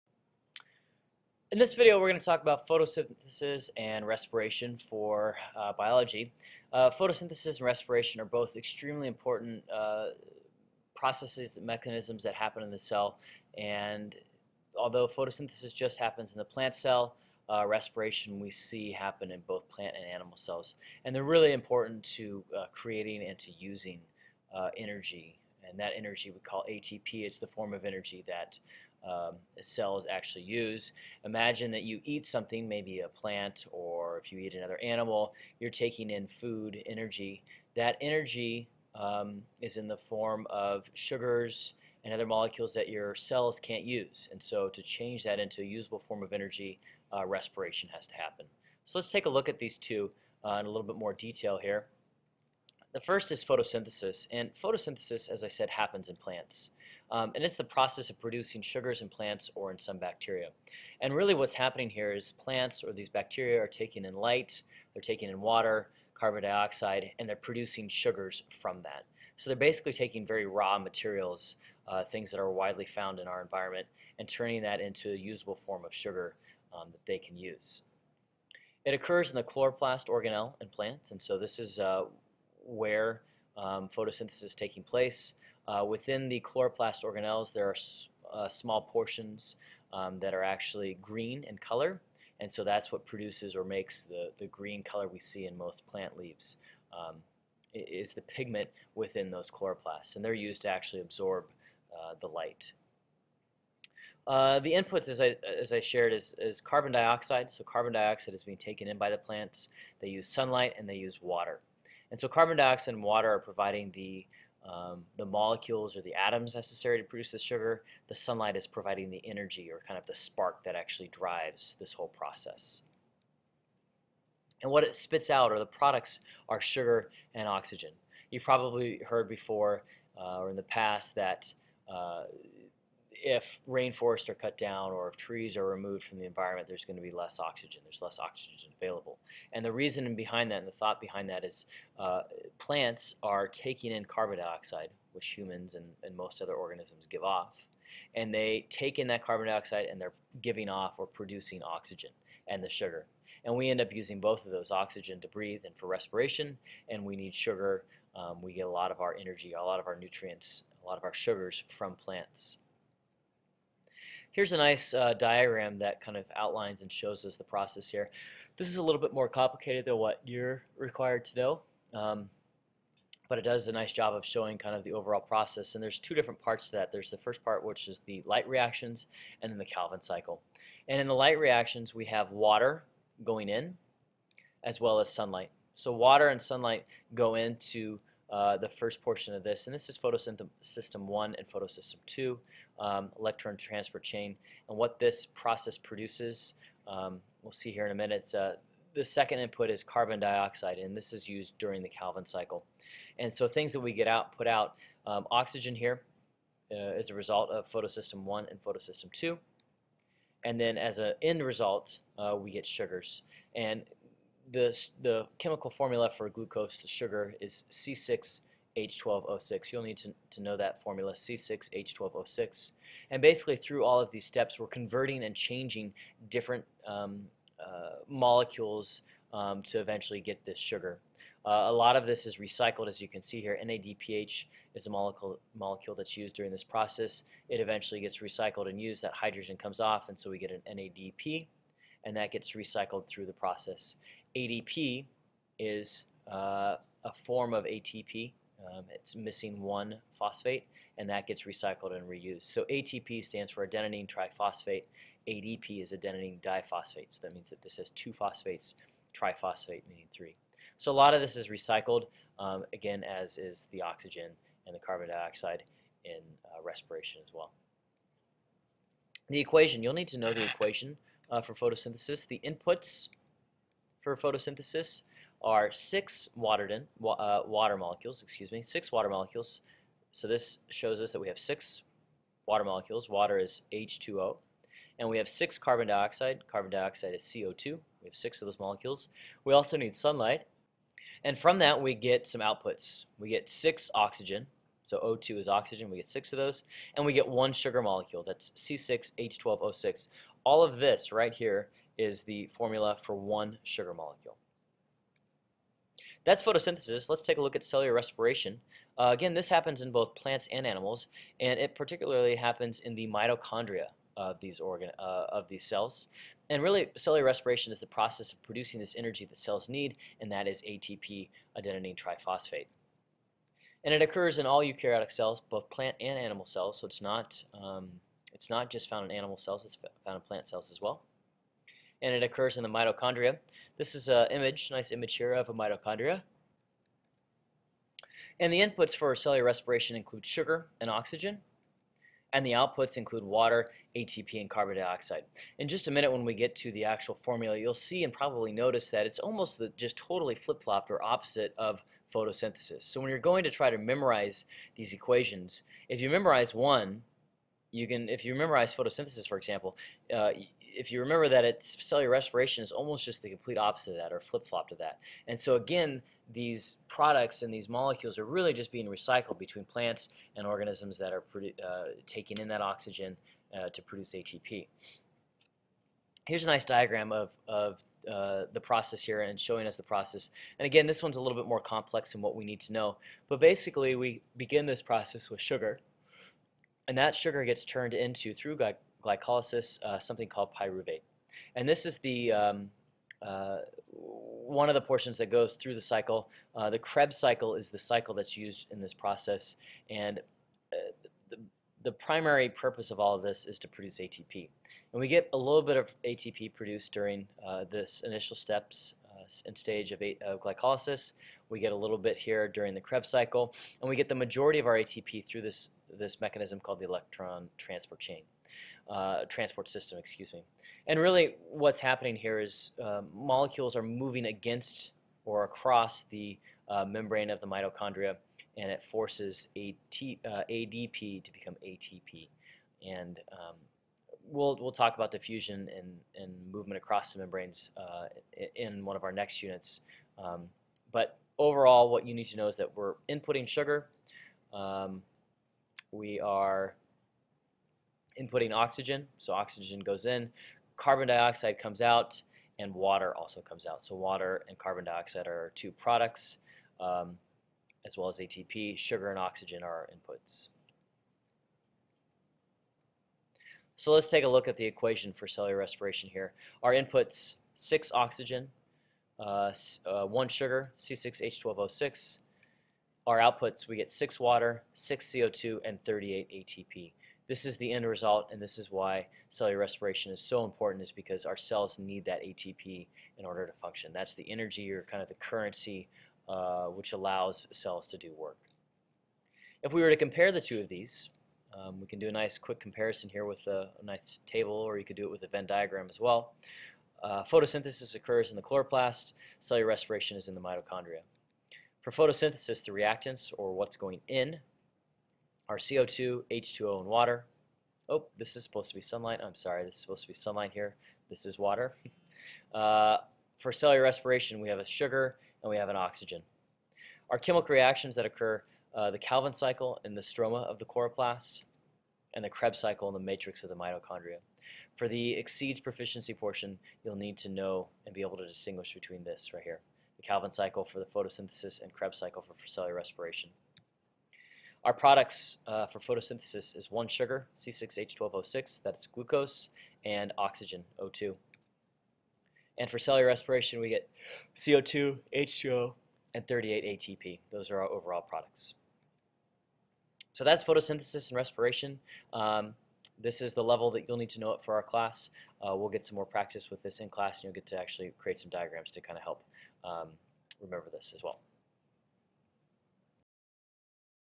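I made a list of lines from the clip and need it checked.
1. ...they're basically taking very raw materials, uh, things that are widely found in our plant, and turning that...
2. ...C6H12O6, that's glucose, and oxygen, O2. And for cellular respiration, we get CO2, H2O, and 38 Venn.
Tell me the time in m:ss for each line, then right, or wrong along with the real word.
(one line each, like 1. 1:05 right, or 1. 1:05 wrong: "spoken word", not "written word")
1. 1:09 wrong: "environment", not "plant"
2. 8:57 wrong: "ATP", not "Venn".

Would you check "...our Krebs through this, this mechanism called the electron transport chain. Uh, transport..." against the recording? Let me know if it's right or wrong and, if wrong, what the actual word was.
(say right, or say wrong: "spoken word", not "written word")
wrong: "ATP", not "Krebs".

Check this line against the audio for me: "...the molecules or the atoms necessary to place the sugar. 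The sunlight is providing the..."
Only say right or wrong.
wrong.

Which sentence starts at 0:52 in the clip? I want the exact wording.
The first is photosynthesis, and photosynthesis, as I said, happens in plants.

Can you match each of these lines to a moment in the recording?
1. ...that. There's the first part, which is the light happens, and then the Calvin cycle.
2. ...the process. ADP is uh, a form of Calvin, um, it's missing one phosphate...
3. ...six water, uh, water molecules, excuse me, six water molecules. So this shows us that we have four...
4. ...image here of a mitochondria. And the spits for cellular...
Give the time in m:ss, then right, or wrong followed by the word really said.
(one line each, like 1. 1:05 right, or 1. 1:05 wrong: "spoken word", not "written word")
1. 2:56 wrong: "reactions", not "happens"
2. 4:03 wrong: "ATP", not "Calvin"
3. 4:35 wrong: "six", not "four"
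4. 5:34 wrong: "inputs", not "spits".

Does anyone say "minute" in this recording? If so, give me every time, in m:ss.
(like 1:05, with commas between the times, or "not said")
3:17, 5:45.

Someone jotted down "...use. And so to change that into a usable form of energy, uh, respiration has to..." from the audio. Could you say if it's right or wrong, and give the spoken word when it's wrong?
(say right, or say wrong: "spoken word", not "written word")
right.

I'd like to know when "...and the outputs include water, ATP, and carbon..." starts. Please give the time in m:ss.
5:42.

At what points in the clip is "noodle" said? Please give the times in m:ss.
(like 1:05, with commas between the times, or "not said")
not said.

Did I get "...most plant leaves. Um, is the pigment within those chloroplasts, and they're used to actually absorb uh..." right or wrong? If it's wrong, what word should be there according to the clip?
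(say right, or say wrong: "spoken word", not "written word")
right.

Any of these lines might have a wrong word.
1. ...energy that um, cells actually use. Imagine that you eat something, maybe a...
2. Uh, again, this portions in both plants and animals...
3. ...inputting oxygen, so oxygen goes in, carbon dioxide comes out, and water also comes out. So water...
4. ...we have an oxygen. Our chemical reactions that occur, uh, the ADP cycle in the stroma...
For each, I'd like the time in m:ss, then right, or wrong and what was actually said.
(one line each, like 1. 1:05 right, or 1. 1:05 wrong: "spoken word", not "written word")
1. 0:27 right
2. 5:08 wrong: "happens", not "portions"
3. 7:28 right
4. 8:35 wrong: "Calvin", not "ADP".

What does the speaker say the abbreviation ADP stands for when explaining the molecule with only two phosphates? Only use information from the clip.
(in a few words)
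adenine diphosphate.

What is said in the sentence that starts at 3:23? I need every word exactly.
And so things that we get out, put out, um, oxygen here uh, is a result of photosystem 1 and photosystem 2.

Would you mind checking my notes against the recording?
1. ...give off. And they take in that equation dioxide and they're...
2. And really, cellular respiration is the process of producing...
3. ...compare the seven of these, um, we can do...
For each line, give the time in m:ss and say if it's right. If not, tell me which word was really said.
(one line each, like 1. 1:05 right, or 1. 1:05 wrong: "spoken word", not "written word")
1. 2:27 wrong: "carbon", not "equation"
2. 5:16 right
3. 8:09 wrong: "two", not "seven".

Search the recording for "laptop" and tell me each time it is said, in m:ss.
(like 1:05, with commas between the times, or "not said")
not said.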